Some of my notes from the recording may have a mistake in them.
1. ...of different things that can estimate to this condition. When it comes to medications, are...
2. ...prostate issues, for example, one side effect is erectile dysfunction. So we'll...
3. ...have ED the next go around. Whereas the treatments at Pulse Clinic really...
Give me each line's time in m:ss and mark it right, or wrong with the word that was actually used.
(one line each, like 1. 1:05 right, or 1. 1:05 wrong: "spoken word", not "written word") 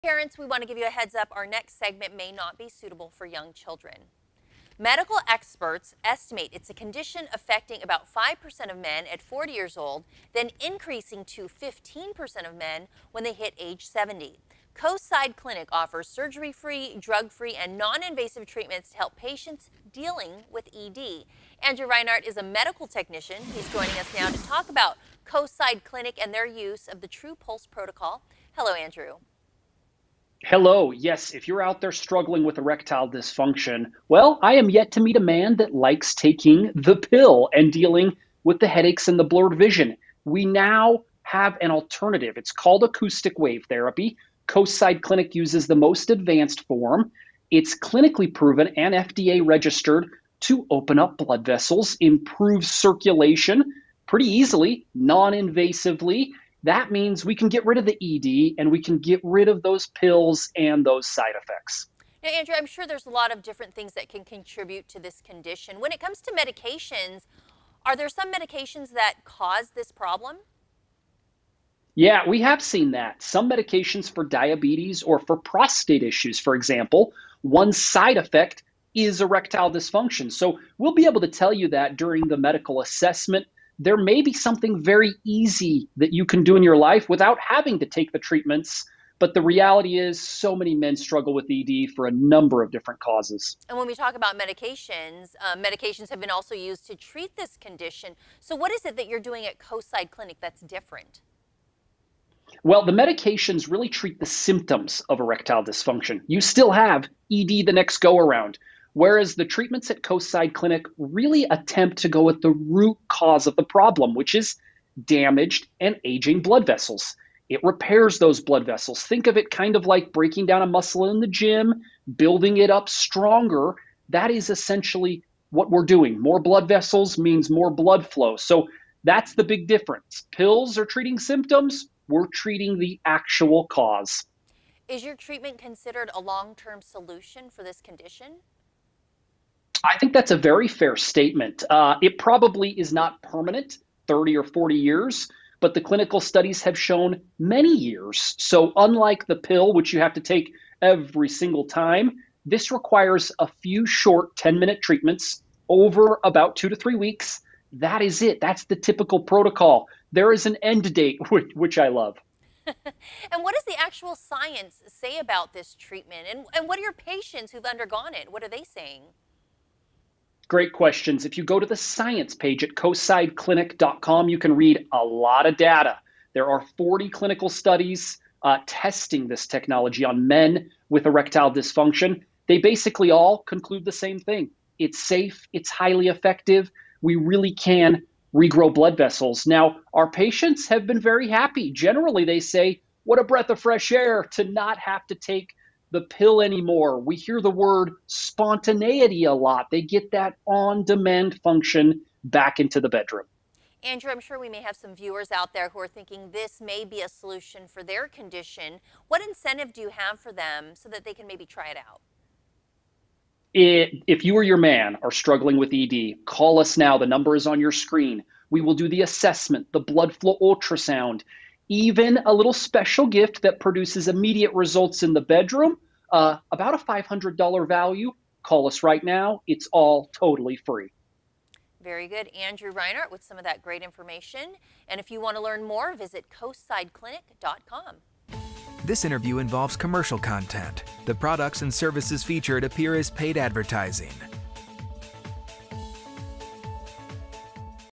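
1. 1:03 wrong: "contribute", not "estimate"
2. 1:15 right
3. 1:46 wrong: "Coastside", not "Pulse".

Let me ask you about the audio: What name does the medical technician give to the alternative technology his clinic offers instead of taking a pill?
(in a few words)
Acoustic wave therapy.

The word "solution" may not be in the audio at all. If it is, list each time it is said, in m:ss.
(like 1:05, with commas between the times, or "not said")
2:16, 3:27.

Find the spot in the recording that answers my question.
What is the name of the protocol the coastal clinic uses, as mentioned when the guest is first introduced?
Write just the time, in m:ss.
0:27.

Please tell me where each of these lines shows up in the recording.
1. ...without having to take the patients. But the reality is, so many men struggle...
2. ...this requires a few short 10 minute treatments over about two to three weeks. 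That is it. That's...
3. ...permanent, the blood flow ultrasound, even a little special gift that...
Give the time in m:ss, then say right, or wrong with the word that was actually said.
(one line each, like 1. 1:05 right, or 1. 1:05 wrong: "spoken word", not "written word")
1. 1:27 wrong: "treatments", not "patients"
2. 2:32 right
3. 3:39 wrong: "assessment", not "permanent".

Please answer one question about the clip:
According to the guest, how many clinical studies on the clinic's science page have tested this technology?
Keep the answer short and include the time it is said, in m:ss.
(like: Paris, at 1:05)
40, at 2:56.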